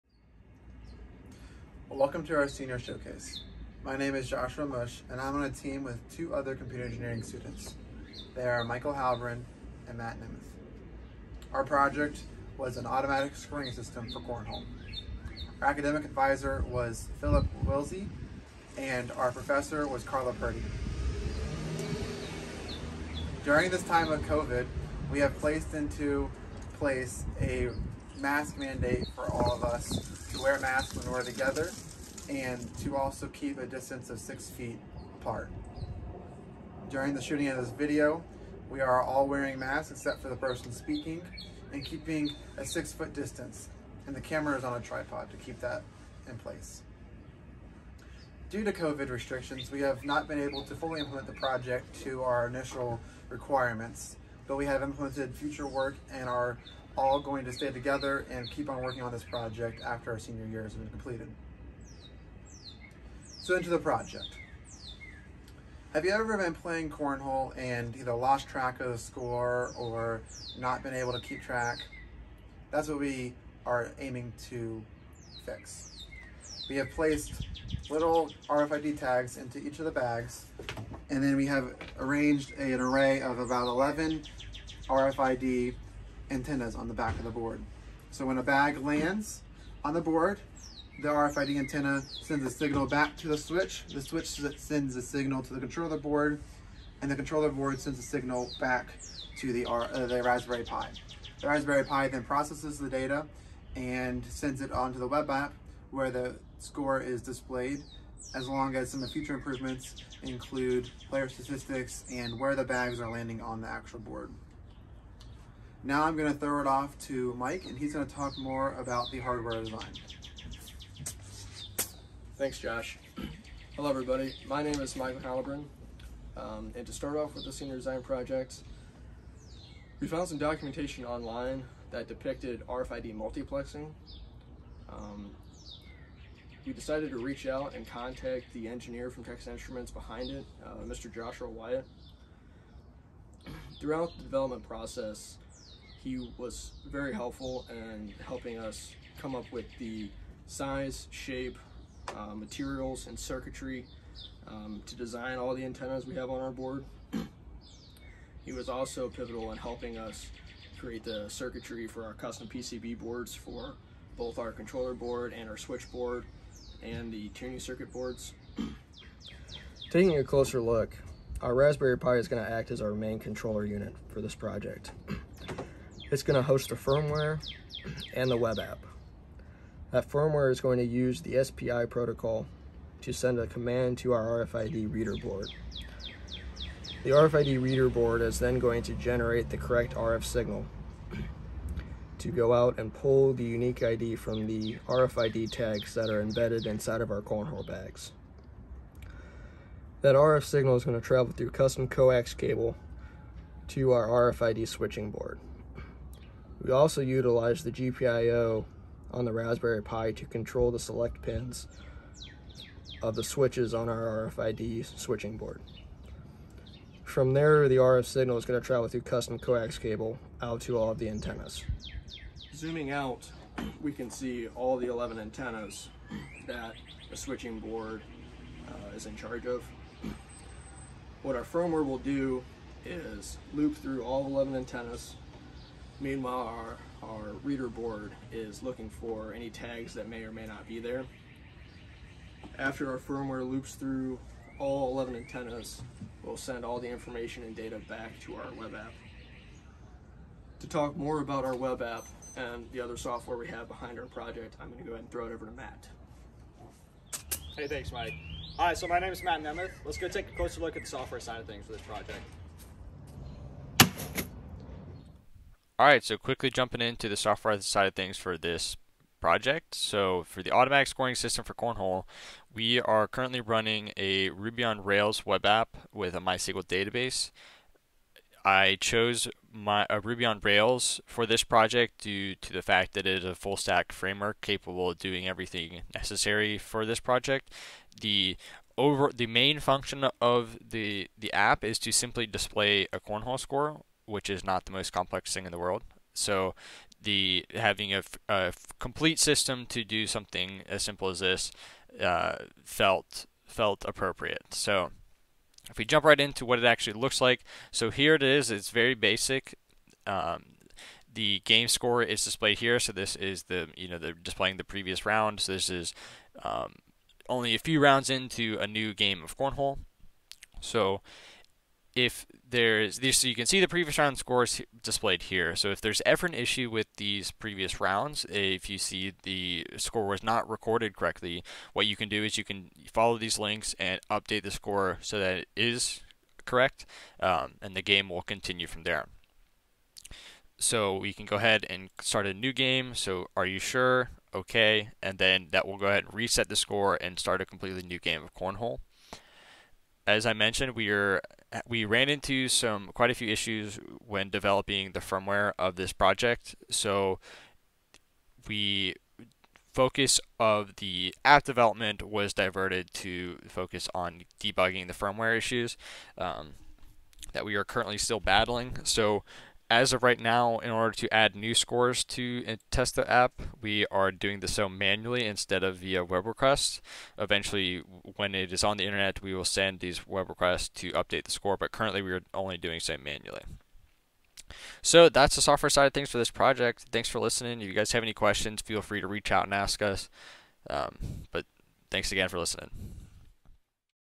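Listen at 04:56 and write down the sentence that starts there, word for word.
So the having a, a complete system to do something as simple as this uh, felt felt appropriate.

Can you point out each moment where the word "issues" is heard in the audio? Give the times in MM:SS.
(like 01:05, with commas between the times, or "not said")
05:26, 05:53, 06:05.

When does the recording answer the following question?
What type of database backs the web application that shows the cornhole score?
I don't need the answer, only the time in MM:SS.
04:36.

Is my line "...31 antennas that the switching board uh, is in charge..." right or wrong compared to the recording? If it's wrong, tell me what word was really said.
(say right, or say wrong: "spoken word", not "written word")
wrong: "11", not "31".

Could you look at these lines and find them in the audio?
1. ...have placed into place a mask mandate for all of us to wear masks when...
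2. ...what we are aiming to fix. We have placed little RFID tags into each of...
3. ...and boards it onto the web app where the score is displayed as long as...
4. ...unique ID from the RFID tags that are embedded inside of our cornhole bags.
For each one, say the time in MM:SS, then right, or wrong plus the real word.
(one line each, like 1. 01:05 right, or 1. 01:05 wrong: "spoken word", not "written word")
1. 00:25 right
2. 01:12 right
3. 01:43 wrong: "sends", not "boards"
4. 03:13 right.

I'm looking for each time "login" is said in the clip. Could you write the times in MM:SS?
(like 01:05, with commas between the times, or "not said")
not said.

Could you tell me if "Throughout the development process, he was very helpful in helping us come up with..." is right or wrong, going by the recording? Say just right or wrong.
right.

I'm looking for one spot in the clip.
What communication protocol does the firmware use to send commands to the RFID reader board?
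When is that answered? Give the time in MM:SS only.
03:01.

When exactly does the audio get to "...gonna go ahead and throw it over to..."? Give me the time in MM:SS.
04:14.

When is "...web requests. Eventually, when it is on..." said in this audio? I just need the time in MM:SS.
06:16.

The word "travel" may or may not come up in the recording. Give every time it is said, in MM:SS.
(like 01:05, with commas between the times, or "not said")
03:21, 03:38.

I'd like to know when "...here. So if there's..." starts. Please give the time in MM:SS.
05:25.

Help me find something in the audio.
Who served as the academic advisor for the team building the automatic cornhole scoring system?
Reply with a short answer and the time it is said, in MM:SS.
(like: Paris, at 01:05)
Philip Wilsey, at 00:17.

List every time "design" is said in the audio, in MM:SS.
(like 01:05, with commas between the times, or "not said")
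01:59, 02:07, 02:34.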